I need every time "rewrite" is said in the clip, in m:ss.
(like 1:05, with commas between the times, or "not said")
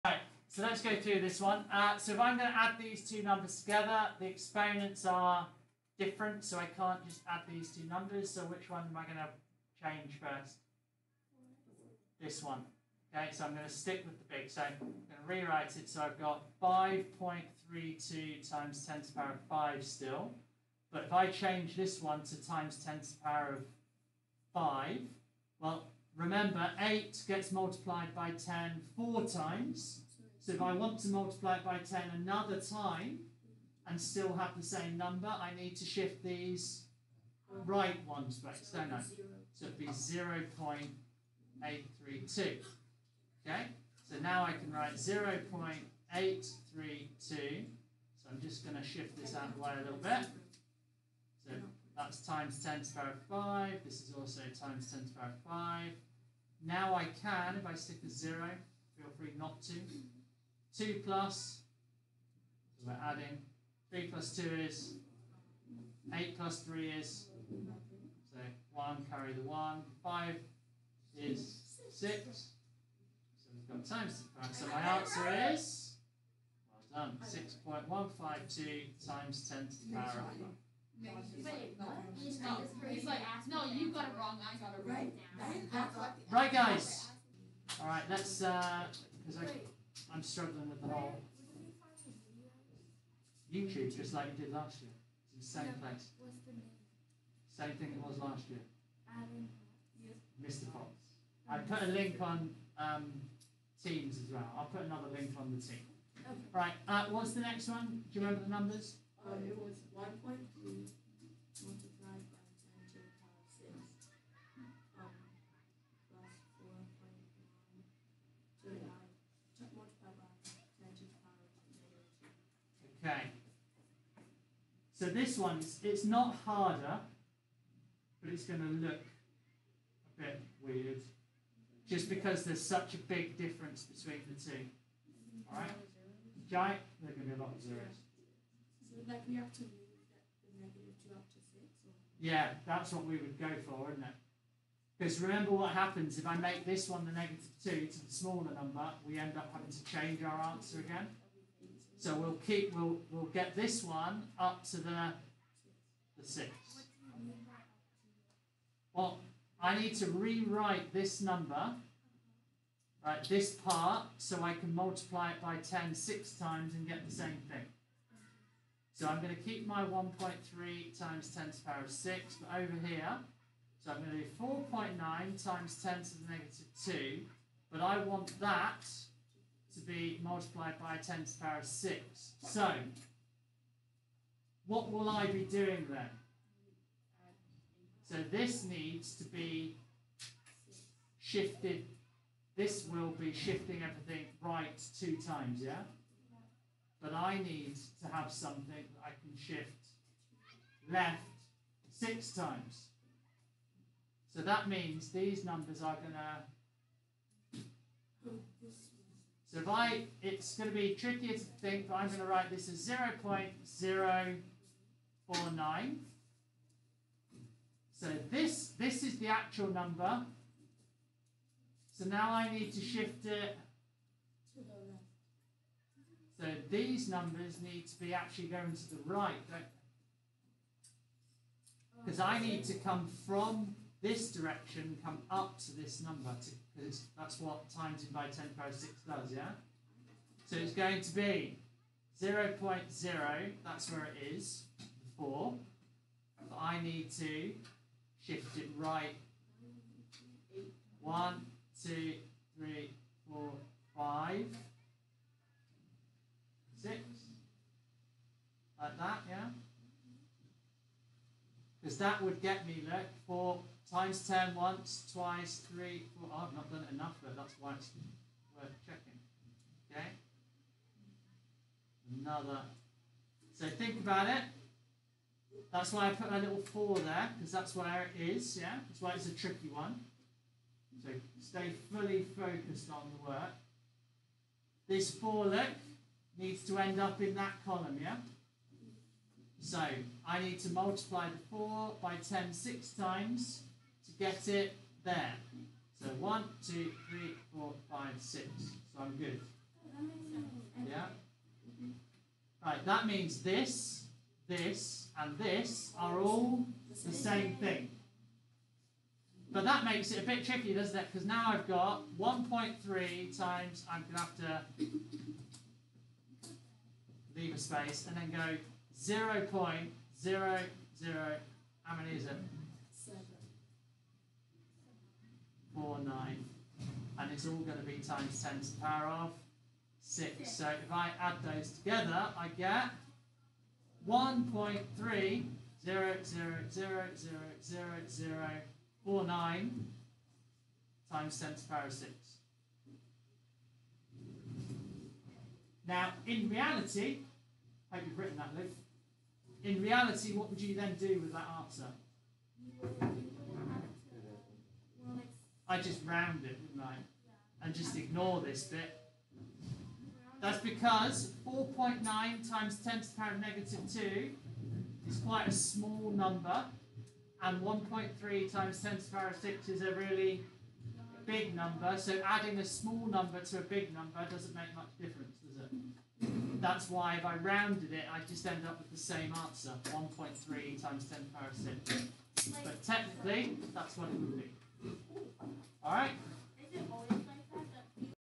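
0:15, 2:40.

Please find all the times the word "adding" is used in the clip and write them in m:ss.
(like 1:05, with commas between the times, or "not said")
1:03, 6:12.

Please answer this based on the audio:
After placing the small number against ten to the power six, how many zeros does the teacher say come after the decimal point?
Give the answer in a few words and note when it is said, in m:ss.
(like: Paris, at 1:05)
7, at 5:22.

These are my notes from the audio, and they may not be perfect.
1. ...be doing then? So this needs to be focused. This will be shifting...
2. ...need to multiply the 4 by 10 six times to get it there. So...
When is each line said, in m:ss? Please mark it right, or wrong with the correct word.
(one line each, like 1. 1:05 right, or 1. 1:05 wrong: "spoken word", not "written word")
1. 3:05 wrong: "shifted", not "focused"
2. 4:50 right.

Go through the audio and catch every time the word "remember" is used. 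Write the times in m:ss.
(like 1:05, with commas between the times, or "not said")
0:26, 1:48, 2:25.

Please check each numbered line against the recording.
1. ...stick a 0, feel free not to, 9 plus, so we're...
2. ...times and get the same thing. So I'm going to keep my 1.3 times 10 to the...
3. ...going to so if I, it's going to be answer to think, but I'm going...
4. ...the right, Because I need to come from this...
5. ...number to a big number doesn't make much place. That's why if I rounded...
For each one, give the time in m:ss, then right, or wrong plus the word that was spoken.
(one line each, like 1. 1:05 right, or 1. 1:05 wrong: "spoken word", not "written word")
1. 0:57 wrong: "2", not "9"
2. 2:46 right
3. 3:25 wrong: "trickier", not "answer"
4. 3:48 right
5. 6:13 wrong: "difference", not "place".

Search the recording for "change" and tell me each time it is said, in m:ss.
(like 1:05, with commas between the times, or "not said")
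0:09, 0:21, 2:29.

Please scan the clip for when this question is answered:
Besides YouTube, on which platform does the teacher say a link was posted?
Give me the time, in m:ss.
1:43.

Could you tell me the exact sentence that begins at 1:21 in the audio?
No, he's like, no, you got it wrong, I got it right.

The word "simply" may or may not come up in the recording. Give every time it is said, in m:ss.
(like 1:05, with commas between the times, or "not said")
not said.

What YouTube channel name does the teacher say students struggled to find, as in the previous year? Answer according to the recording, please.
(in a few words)
Mr. Fox.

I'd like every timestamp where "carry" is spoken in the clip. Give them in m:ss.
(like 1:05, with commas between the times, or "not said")
1:09.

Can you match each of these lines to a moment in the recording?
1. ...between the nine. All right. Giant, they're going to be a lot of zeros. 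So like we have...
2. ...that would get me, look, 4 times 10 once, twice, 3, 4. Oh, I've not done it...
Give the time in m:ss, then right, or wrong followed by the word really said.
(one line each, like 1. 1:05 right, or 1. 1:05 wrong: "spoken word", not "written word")
1. 2:13 wrong: "two", not "nine"
2. 4:22 right.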